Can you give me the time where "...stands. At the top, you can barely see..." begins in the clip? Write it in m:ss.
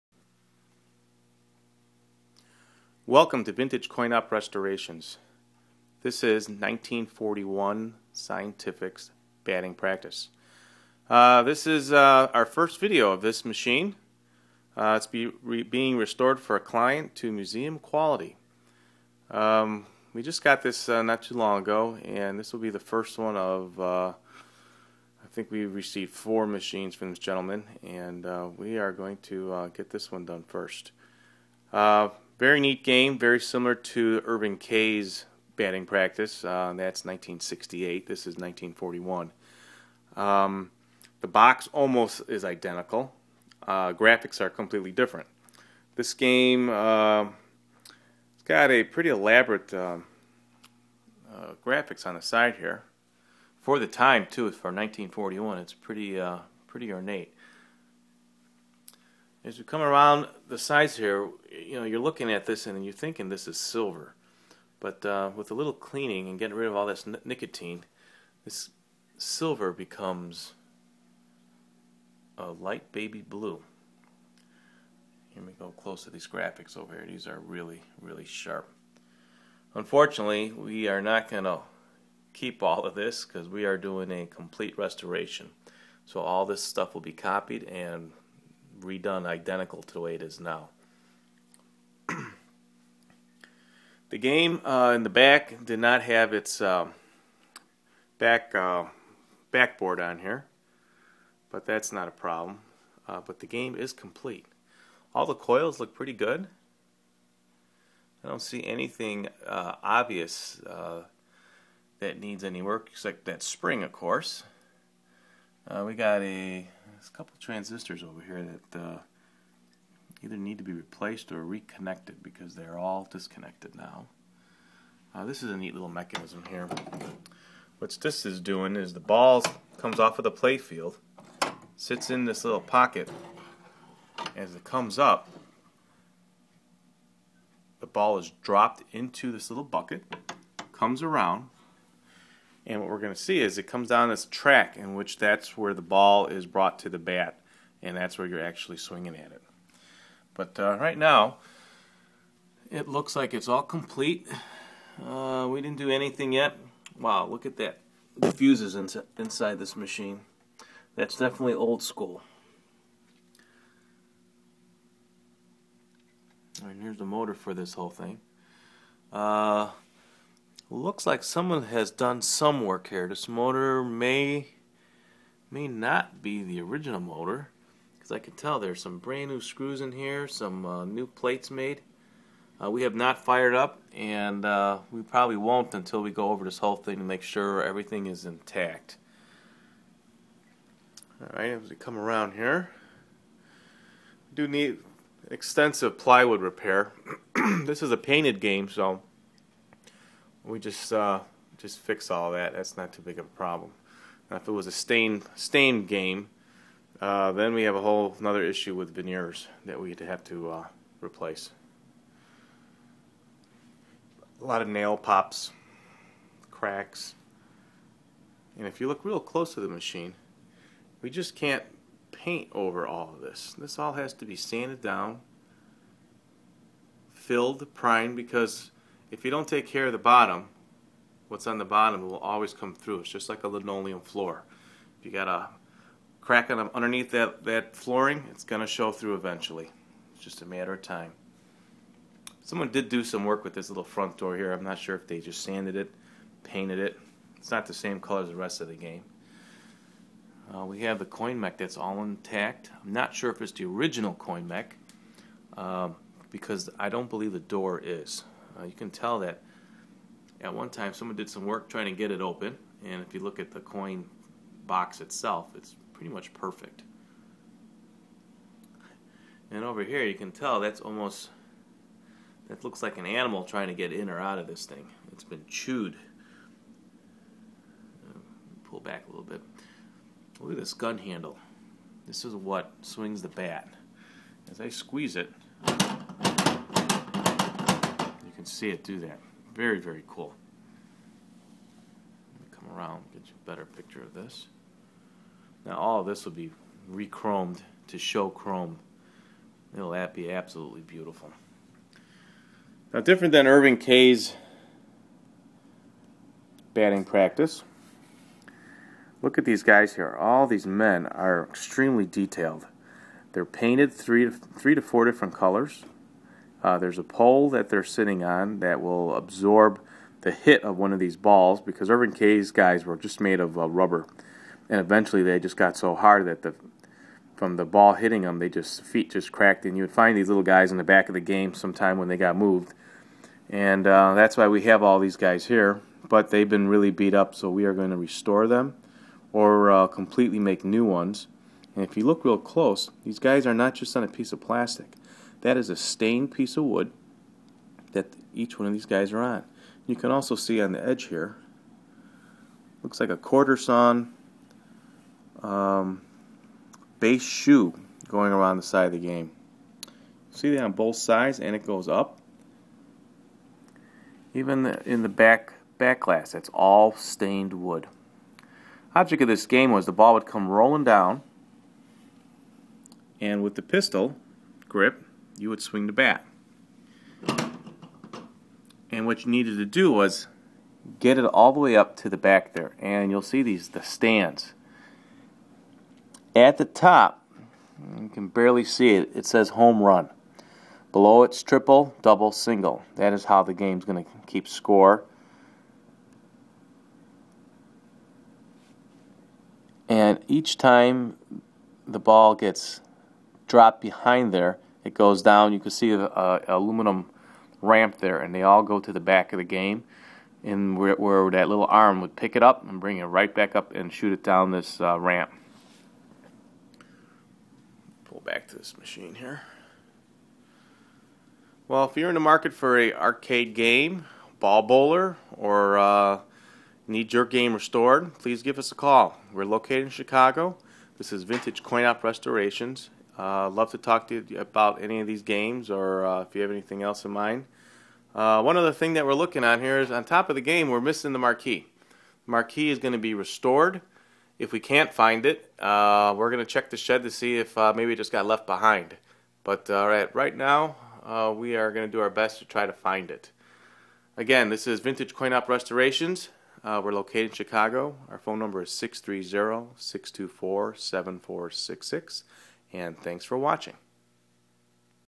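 6:23.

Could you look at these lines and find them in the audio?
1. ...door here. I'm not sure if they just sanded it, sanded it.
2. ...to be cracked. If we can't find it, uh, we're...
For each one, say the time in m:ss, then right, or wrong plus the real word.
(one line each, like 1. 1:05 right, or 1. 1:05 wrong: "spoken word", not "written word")
1. 4:04 wrong: "painted", not "sanded"
2. 7:22 wrong: "restored", not "cracked".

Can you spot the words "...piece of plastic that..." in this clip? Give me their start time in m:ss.
5:44.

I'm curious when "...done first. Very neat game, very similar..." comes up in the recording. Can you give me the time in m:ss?
0:30.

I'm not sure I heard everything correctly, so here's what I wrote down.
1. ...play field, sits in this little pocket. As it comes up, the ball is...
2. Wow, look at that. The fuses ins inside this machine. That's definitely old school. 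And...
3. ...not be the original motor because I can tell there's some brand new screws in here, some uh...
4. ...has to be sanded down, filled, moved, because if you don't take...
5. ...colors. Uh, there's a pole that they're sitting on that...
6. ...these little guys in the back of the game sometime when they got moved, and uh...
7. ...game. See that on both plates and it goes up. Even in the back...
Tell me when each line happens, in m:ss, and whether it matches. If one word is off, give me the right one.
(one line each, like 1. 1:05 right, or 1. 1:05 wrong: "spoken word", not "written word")
1. 2:10 right
2. 2:36 right
3. 2:55 right
4. 3:43 wrong: "primed", not "moved"
5. 5:15 right
6. 5:30 right
7. 5:58 wrong: "sides", not "plates".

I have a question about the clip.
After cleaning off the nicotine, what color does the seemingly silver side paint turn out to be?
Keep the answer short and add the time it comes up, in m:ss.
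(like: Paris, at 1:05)
light baby blue, at 1:12.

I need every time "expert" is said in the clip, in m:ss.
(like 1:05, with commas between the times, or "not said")
not said.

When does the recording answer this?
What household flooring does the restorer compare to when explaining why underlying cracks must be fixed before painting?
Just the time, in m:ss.
3:53.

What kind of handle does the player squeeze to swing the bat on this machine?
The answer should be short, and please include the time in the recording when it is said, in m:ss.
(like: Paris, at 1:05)
gun handle, at 4:40.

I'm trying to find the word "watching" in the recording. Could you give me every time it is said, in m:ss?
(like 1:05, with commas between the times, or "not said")
7:43.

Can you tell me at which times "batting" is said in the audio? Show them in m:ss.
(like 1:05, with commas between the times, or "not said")
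0:09, 0:35, 5:06.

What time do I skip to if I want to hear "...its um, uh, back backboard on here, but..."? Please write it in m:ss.
1:36.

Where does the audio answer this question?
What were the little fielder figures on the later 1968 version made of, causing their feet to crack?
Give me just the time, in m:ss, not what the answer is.
5:23.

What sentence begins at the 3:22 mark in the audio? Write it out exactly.
That's not too big of a problem.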